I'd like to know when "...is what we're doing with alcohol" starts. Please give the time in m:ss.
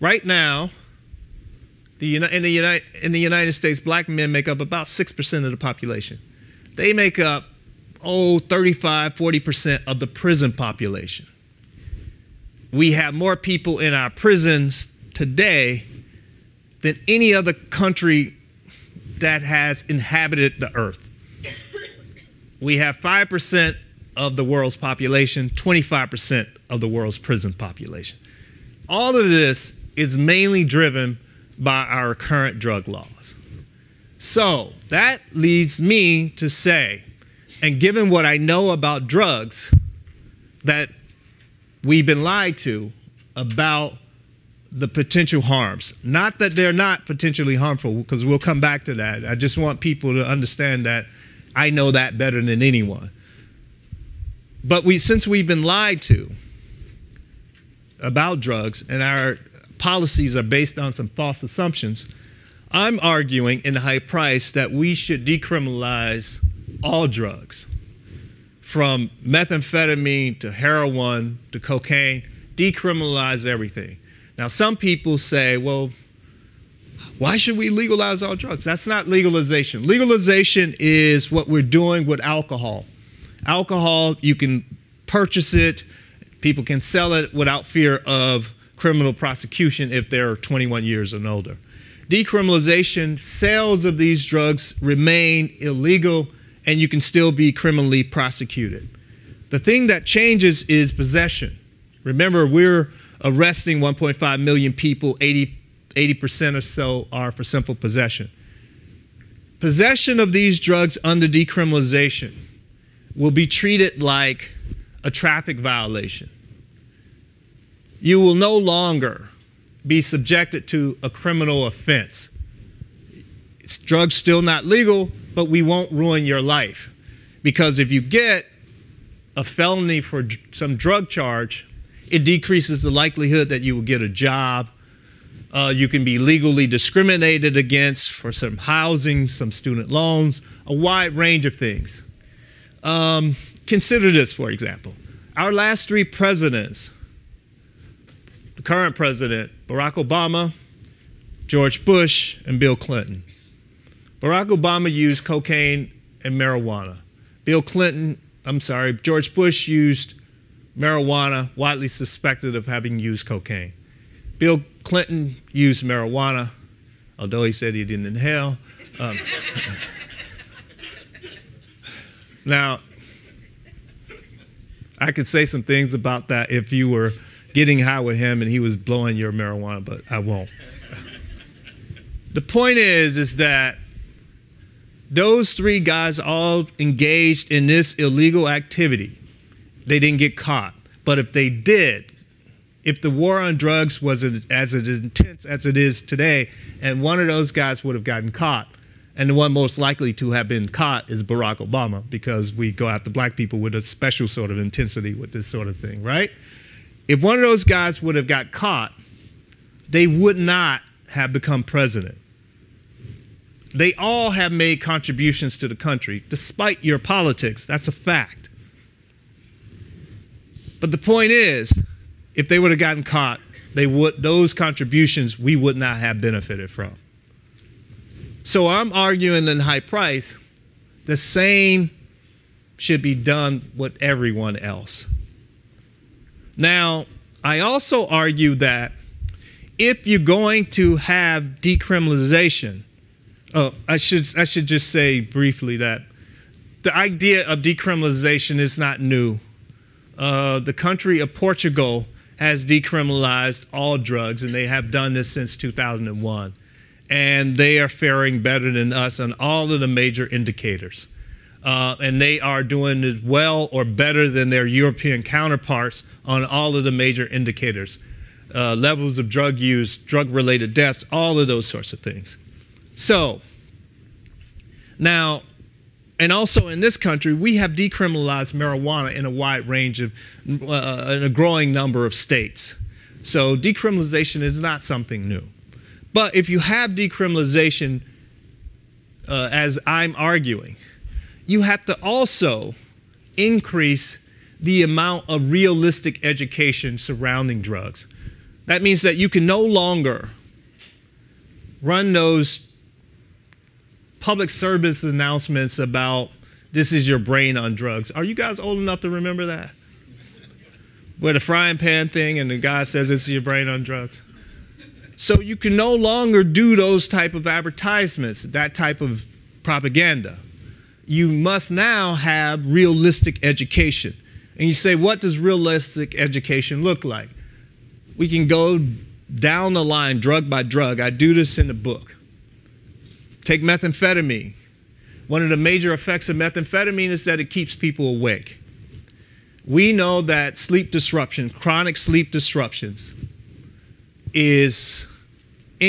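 1:20.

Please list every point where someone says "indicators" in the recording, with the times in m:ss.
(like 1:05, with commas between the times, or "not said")
4:20, 4:27.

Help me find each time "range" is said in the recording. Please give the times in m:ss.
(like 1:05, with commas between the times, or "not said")
2:21, 4:39.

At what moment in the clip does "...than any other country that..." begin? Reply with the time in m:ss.
0:16.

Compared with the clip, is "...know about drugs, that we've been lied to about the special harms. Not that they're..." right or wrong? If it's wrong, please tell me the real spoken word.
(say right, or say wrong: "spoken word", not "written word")
wrong: "potential", not "special".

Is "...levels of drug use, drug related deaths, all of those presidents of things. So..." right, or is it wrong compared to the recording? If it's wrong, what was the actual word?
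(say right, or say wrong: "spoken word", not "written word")
wrong: "sorts", not "presidents".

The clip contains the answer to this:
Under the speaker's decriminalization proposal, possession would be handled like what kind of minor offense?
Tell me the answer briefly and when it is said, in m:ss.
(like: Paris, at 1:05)
A traffic violation, at 1:55.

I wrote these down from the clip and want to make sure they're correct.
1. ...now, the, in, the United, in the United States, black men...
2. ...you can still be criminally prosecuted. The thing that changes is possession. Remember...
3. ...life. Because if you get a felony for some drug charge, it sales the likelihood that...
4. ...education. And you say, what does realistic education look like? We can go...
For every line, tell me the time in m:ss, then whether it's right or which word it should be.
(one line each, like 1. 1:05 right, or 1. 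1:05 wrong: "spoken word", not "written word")
1. 0:00 right
2. 1:36 right
3. 2:06 wrong: "decreases", not "sales"
4. 5:23 right.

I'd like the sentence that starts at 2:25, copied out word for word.
Our last three presidents, the current president, Barack Obama, George Bush, and Bill Clinton.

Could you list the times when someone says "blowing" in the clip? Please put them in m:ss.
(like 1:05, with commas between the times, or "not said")
2:58.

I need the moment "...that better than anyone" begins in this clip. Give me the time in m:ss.
0:51.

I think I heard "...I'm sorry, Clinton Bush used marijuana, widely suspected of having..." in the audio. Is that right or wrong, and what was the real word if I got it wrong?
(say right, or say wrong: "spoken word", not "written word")
wrong: "George", not "Clinton".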